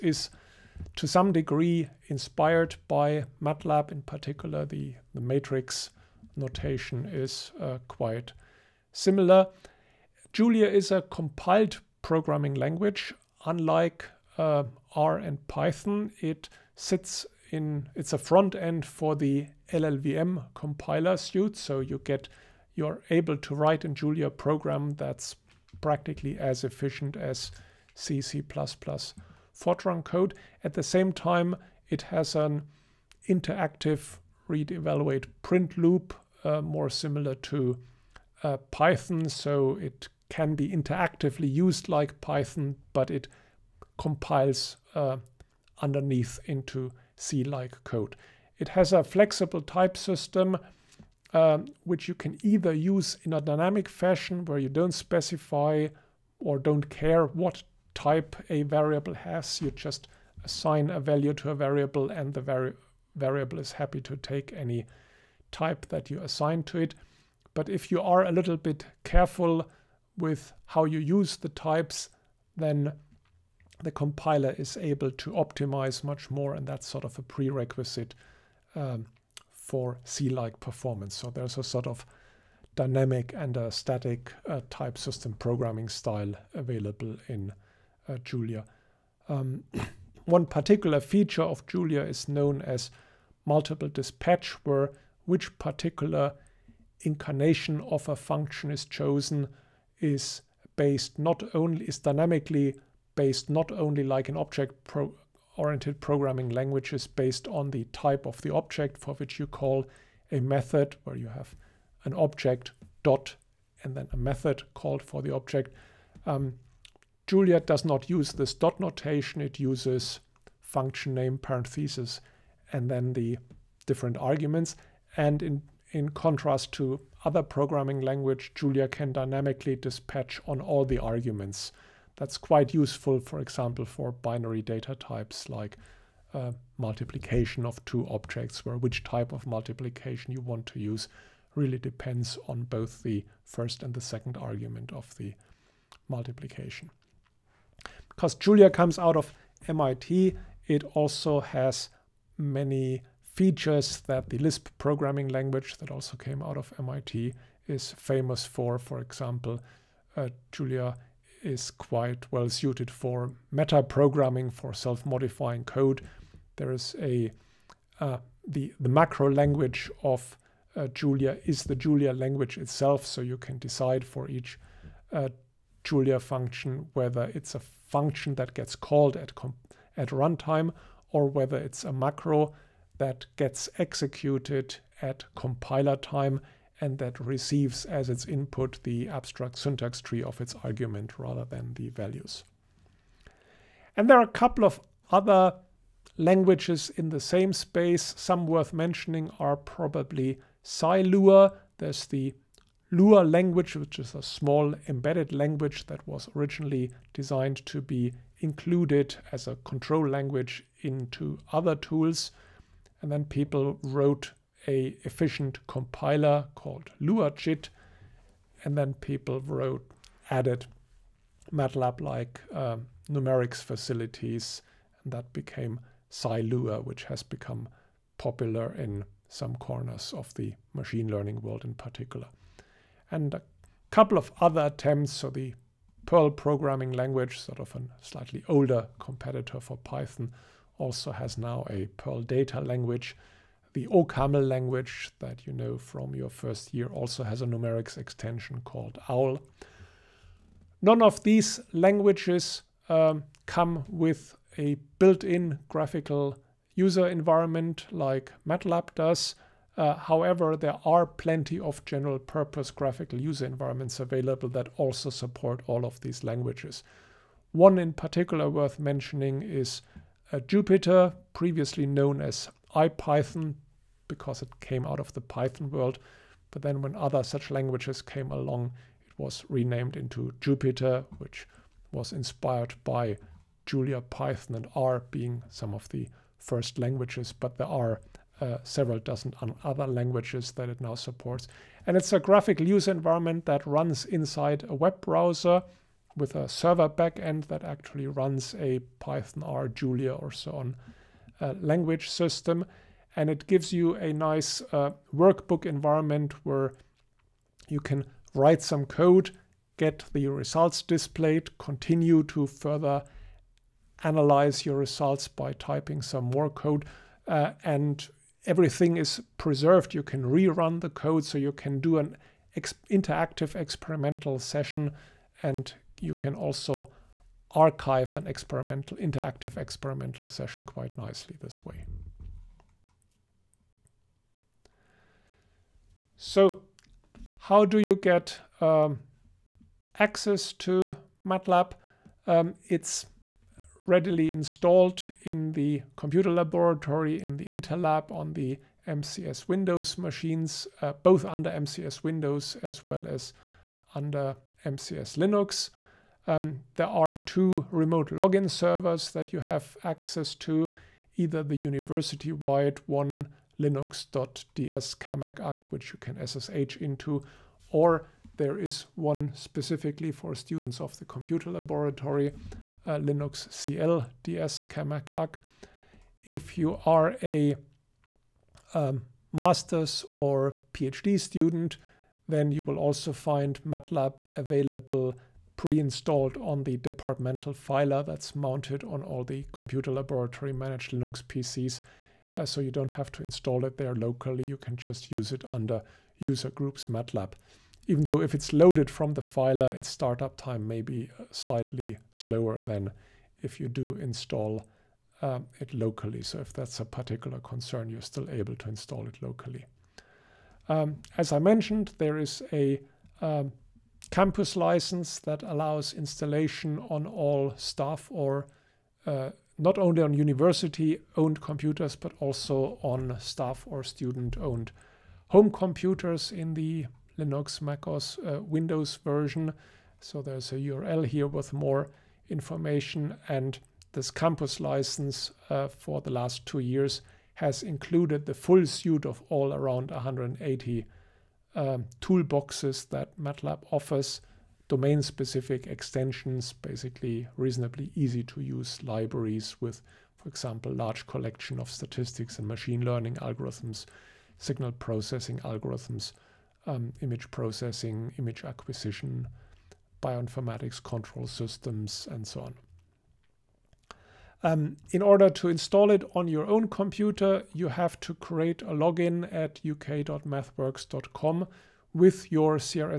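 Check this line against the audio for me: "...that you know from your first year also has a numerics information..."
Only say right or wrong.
wrong.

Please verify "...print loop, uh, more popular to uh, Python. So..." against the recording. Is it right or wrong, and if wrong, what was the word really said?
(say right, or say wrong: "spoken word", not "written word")
wrong: "similar", not "popular".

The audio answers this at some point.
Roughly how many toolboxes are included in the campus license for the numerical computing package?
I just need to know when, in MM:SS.
07:19.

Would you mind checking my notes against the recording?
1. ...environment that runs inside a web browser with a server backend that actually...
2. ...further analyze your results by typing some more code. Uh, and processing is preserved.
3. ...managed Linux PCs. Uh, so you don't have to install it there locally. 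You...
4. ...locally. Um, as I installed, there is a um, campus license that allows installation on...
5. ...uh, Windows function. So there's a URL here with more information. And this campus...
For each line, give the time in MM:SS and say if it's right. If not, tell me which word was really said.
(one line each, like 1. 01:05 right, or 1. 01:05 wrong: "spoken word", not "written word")
1. 04:52 right
2. 05:12 wrong: "everything", not "processing"
3. 06:30 right
4. 06:49 wrong: "mentioned", not "installed"
5. 07:08 wrong: "version", not "function".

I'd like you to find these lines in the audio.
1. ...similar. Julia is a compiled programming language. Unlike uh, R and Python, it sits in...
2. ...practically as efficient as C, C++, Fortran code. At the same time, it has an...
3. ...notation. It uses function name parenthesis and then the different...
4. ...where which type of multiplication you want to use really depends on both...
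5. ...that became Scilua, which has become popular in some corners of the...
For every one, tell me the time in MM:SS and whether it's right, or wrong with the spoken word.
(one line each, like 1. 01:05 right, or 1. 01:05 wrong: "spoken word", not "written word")
1. 00:08 right
2. 00:25 right
3. 01:58 right
4. 02:18 right
5. 03:45 right.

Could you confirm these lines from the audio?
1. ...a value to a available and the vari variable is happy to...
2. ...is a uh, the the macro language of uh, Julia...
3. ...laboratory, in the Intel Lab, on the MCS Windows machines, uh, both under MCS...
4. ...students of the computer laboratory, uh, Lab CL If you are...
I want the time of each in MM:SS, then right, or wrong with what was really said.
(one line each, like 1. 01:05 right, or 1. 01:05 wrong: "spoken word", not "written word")
1. 01:00 wrong: "variable", not "available"
2. 02:46 right
3. 05:46 right
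4. 06:10 wrong: "Linux", not "Lab".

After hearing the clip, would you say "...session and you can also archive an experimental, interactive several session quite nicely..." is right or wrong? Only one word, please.
wrong.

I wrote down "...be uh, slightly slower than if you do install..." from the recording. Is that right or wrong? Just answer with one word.
right.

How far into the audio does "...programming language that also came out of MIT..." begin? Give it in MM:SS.
02:34.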